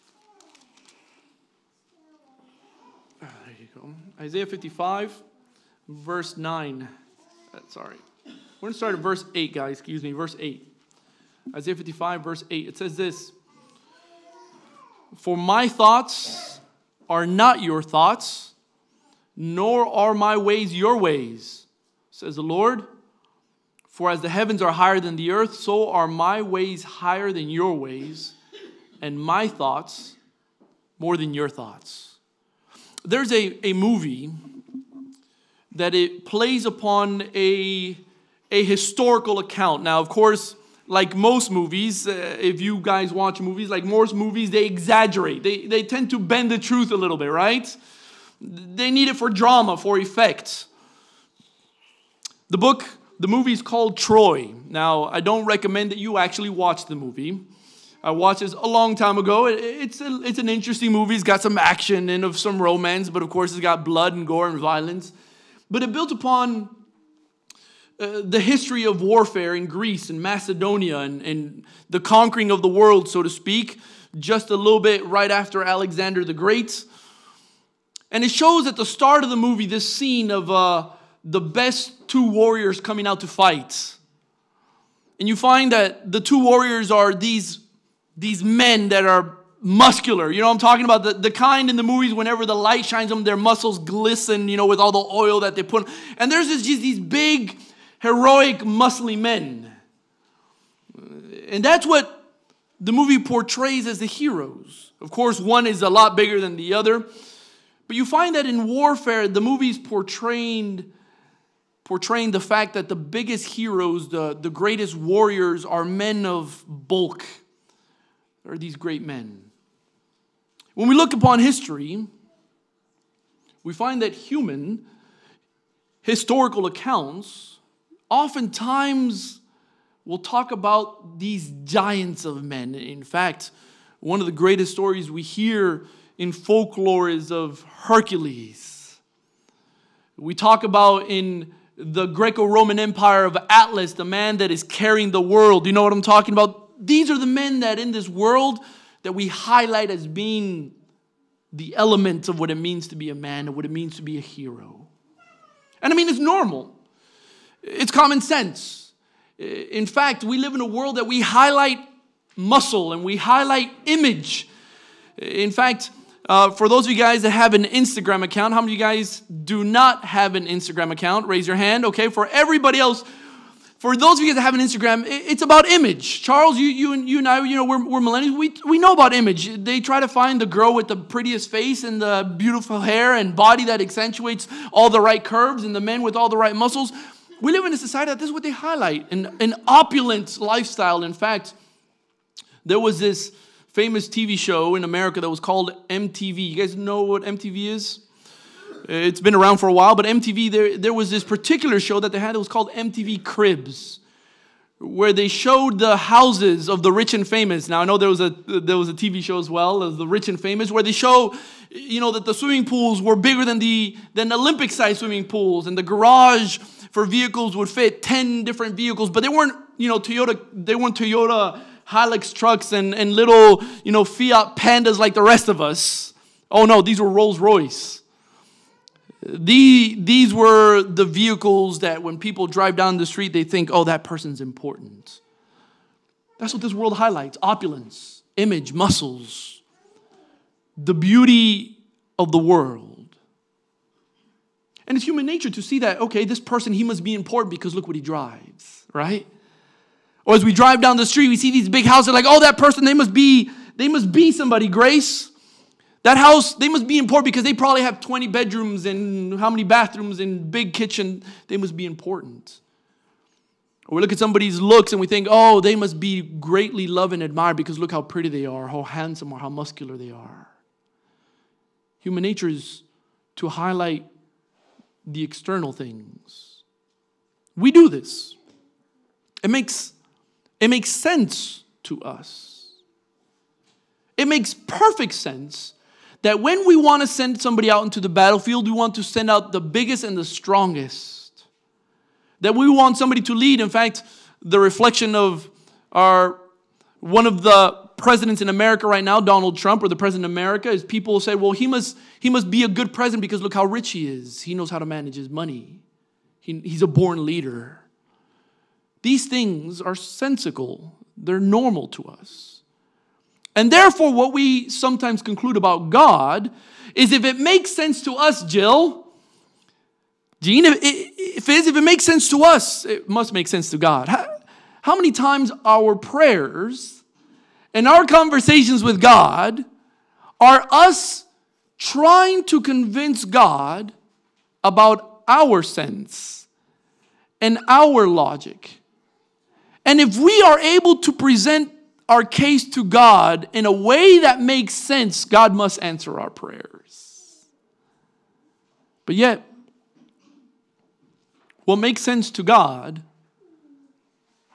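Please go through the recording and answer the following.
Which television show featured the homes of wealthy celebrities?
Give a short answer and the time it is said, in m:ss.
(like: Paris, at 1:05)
MTV Cribs, at 3:22.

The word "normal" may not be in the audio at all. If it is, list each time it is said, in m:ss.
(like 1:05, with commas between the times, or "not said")
2:36, 5:11.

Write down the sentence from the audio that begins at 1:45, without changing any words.
Of course, one is a lot bigger than the other.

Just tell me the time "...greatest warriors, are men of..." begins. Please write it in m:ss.
1:54.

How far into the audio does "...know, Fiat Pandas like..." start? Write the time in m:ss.
3:43.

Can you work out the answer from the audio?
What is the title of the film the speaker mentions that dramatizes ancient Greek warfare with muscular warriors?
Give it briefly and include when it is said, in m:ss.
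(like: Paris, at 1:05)
Troy, at 0:53.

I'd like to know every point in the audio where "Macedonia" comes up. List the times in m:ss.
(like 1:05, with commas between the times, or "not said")
1:10.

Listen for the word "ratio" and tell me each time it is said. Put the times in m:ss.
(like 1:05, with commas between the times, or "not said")
not said.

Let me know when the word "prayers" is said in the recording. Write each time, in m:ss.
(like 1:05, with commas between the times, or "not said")
5:25, 5:46.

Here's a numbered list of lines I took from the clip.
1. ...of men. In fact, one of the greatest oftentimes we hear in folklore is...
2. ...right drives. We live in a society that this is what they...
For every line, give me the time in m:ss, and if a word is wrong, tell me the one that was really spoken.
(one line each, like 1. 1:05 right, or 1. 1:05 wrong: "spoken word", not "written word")
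1. 2:12 wrong: "stories", not "oftentimes"
2. 3:06 wrong: "muscles", not "drives".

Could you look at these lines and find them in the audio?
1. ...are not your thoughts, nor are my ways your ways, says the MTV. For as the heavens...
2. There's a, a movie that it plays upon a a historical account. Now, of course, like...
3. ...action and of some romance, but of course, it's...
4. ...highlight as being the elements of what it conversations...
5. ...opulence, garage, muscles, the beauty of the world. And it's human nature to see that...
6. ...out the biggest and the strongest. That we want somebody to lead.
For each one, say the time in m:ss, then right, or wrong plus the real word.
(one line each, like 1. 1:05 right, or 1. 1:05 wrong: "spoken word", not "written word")
1. 0:17 wrong: "Lord", not "MTV"
2. 0:33 right
3. 1:01 right
4. 2:29 wrong: "means", not "conversations"
5. 3:57 wrong: "image", not "garage"
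6. 4:49 right.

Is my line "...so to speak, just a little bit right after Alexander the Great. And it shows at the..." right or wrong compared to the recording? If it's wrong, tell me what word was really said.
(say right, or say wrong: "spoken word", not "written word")
right.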